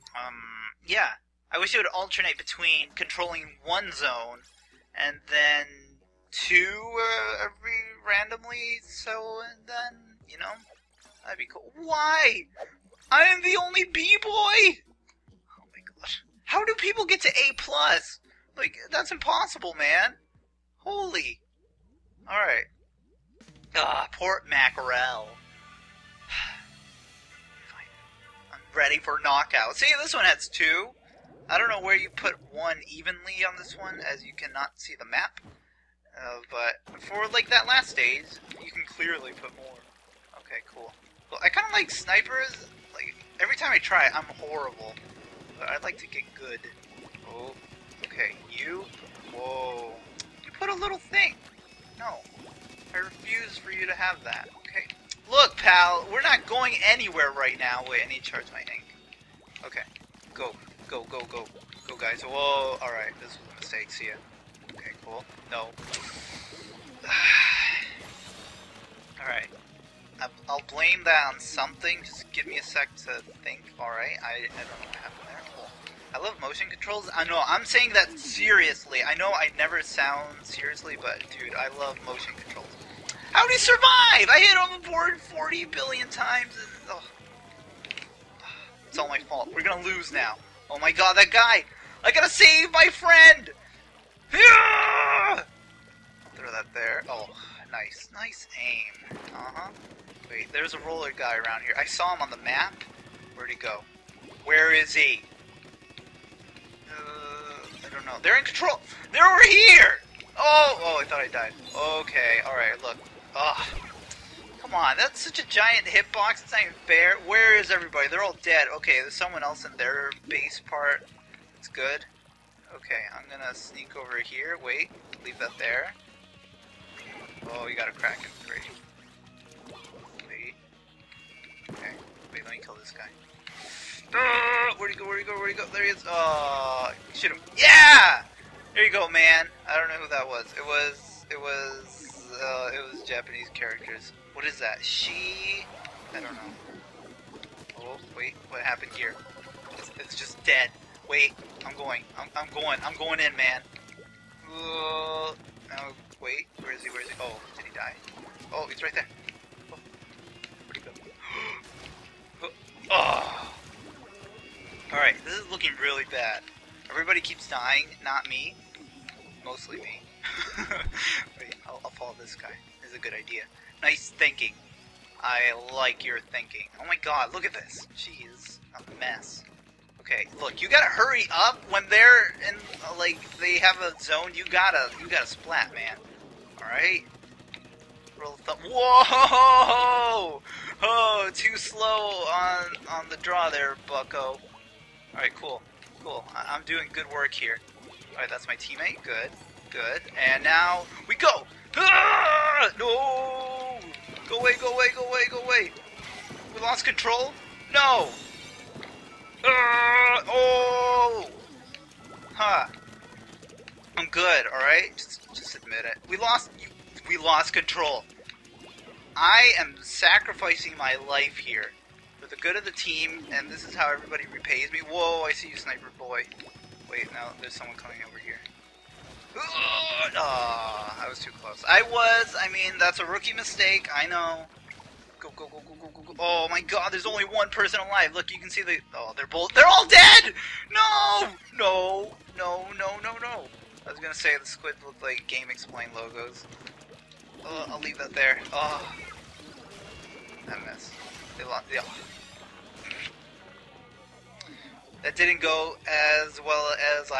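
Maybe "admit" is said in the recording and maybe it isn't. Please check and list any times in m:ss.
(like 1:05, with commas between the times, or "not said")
3:35.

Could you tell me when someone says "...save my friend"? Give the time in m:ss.
1:32.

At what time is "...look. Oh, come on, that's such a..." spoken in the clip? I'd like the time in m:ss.
1:52.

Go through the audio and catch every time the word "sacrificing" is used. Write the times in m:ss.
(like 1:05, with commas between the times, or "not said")
3:39.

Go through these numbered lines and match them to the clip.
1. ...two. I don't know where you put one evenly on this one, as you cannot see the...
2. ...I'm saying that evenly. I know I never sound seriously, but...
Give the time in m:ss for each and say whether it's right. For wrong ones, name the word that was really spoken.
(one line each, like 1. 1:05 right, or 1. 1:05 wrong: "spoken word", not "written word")
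1. 0:30 right
2. 1:17 wrong: "seriously", not "evenly".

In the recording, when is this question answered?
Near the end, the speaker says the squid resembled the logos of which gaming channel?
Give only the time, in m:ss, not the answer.
4:05.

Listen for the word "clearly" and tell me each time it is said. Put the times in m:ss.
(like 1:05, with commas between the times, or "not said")
0:38.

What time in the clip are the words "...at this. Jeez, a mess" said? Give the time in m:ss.
2:57.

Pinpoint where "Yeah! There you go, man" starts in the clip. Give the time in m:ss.
2:17.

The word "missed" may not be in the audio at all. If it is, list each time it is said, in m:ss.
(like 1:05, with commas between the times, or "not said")
4:10.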